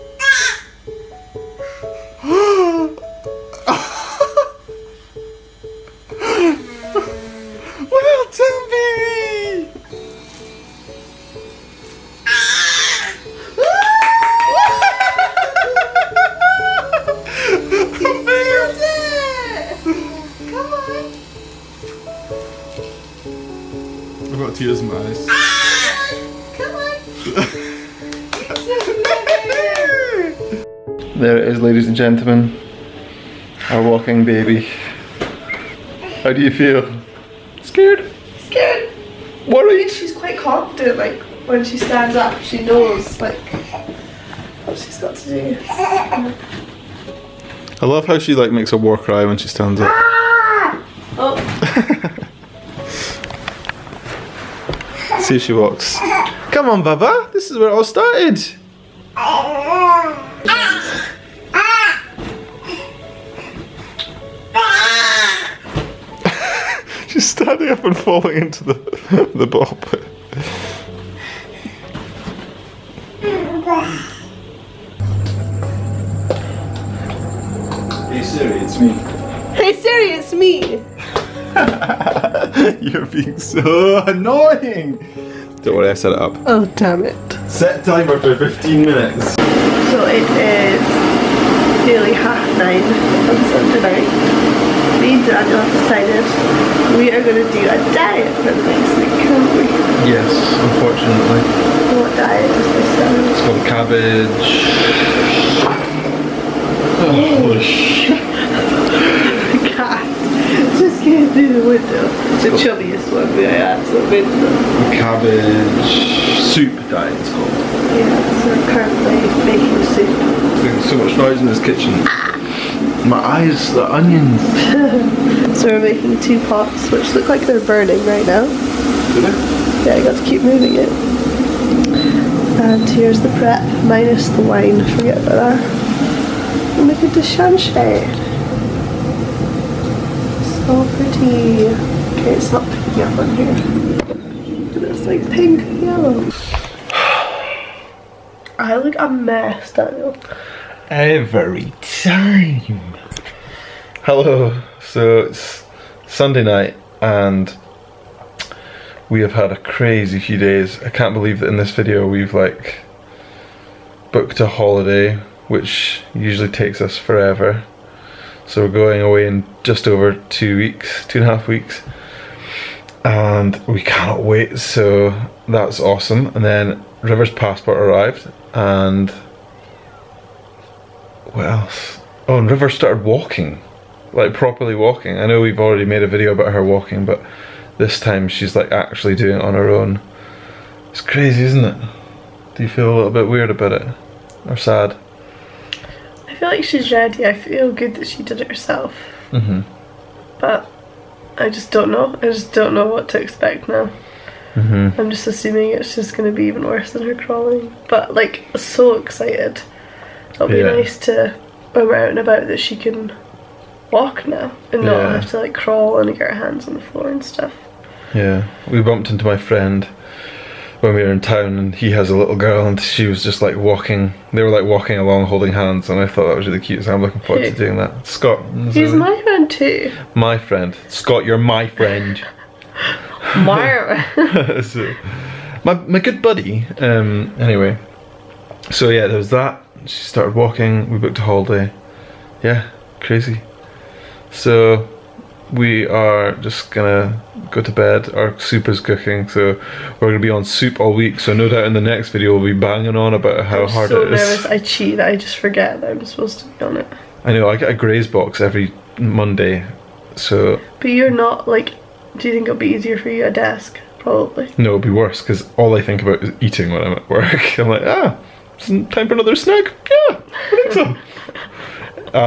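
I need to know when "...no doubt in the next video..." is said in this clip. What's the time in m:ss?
4:11.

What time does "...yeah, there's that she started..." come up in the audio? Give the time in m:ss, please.
3:58.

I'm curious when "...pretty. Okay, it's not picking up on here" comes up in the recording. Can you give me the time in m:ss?
2:20.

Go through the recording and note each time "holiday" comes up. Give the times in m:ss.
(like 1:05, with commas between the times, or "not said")
2:44, 4:01.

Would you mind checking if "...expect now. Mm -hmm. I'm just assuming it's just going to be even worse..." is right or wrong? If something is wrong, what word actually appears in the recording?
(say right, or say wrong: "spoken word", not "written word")
right.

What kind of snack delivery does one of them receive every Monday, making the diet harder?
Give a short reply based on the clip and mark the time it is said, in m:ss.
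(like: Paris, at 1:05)
Graze box, at 4:17.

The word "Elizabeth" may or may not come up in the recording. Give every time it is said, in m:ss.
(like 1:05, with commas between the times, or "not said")
not said.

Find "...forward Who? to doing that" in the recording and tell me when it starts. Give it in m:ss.
3:47.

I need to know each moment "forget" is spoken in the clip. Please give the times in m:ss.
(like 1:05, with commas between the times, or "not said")
2:14, 4:15.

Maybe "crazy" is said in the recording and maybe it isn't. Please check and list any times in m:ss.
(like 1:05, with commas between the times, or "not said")
2:39, 3:11, 4:03.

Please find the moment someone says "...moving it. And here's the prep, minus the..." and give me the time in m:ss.
2:10.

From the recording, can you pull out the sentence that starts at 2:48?
So we're going away in just over two weeks, two and a half weeks.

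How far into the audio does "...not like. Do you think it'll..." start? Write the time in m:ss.
4:21.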